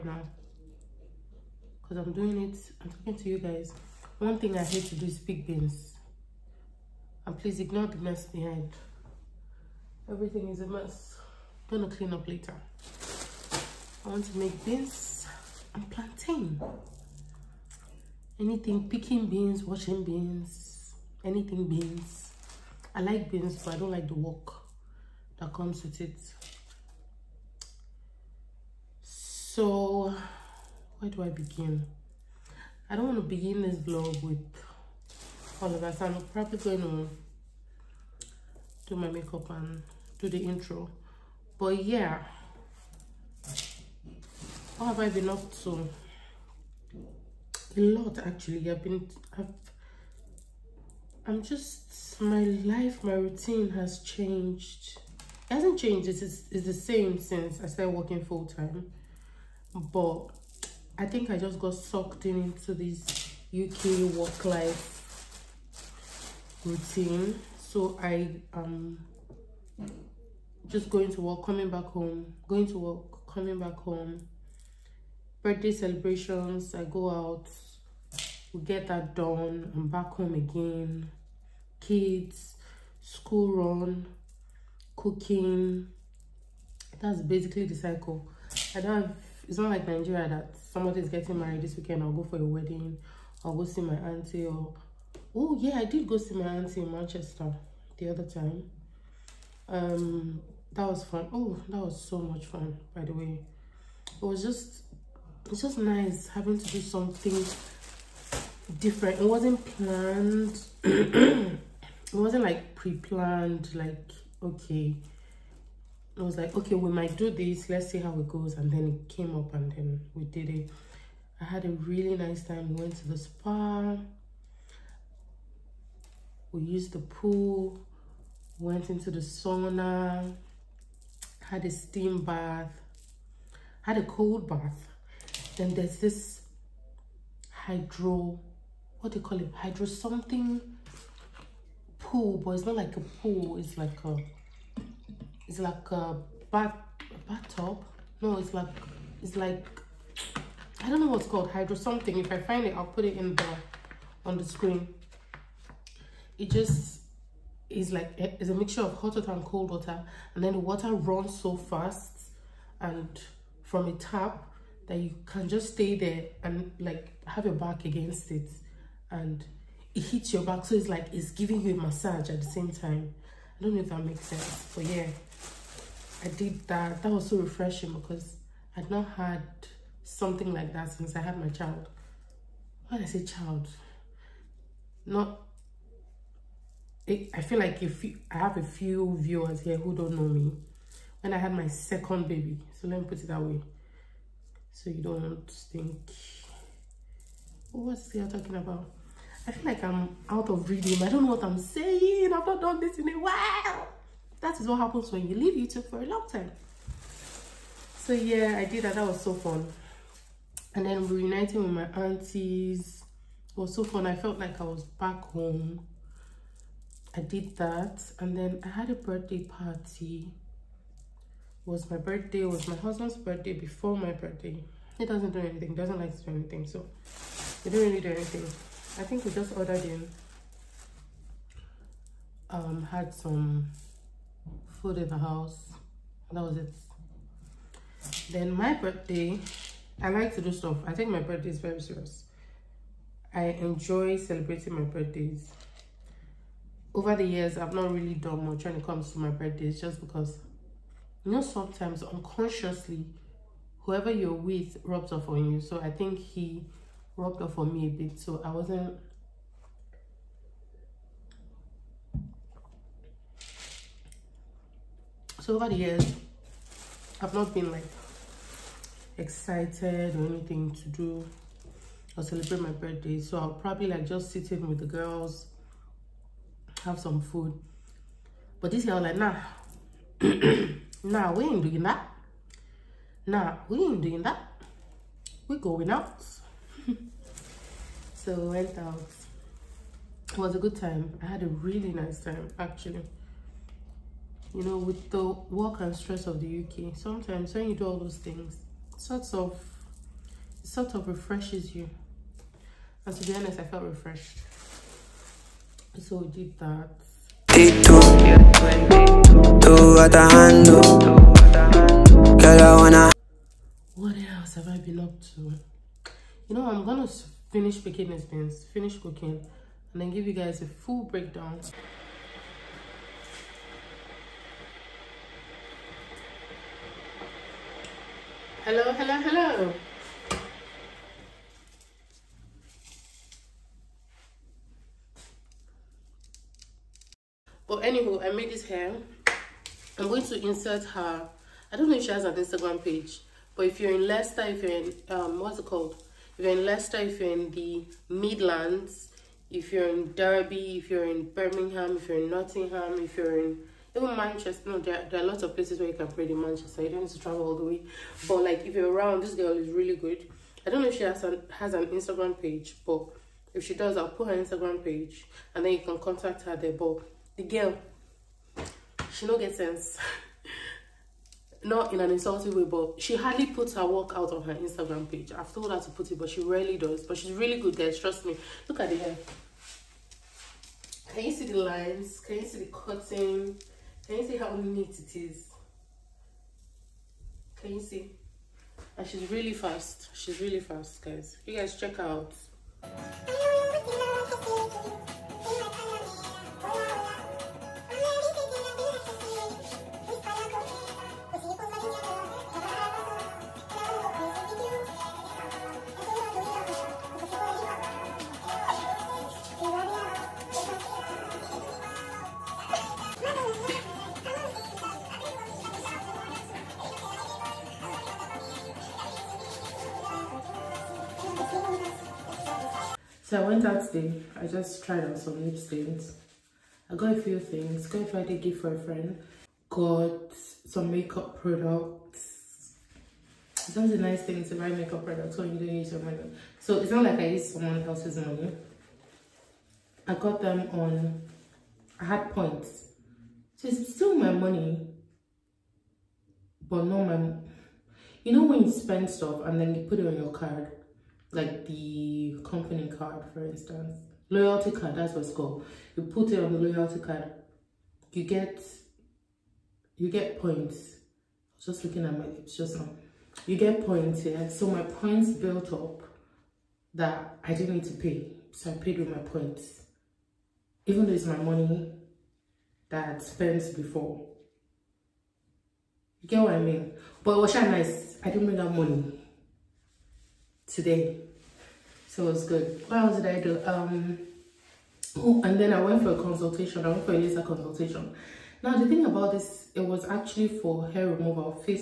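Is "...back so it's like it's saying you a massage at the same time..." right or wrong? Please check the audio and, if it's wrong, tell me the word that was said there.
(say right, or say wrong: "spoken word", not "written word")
wrong: "giving", not "saying".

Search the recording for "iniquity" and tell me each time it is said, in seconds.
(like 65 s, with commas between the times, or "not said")
not said.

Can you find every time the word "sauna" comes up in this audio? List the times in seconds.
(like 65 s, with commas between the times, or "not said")
129 s.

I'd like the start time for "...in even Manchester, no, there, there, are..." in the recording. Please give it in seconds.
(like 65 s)
353 s.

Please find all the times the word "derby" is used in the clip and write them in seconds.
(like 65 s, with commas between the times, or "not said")
350 s.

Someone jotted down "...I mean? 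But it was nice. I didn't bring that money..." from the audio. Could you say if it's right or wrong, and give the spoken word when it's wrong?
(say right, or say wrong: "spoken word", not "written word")
right.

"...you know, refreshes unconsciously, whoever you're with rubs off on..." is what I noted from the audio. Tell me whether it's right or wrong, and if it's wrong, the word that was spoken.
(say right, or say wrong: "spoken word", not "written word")
wrong: "sometimes", not "refreshes".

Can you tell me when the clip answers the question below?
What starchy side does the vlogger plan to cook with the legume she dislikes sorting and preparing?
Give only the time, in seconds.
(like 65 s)
15 s.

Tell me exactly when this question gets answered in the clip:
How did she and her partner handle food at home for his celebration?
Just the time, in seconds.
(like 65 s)
229 s.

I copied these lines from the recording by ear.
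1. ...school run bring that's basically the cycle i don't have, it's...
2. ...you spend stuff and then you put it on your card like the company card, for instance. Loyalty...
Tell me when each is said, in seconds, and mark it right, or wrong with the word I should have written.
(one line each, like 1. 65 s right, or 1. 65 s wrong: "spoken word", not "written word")
1. 83 s wrong: "cooking", not "bring"
2. 448 s right.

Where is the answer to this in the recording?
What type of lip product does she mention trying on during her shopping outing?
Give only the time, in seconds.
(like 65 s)
425 s.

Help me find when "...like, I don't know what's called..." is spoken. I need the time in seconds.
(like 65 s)
149 s.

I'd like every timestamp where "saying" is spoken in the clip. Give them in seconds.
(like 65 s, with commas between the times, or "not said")
201 s.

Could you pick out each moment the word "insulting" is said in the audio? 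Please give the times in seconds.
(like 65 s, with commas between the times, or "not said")
372 s.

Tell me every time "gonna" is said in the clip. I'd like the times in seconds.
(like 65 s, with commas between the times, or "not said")
11 s, 316 s.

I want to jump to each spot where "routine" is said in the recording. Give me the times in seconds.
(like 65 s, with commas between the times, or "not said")
53 s, 66 s.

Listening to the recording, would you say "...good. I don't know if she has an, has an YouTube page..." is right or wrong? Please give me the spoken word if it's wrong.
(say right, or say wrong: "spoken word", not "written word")
wrong: "Instagram", not "YouTube".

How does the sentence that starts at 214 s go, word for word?
I felt like I was back home I did that and then I had a birthday party.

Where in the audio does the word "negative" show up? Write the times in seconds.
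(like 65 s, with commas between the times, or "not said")
not said.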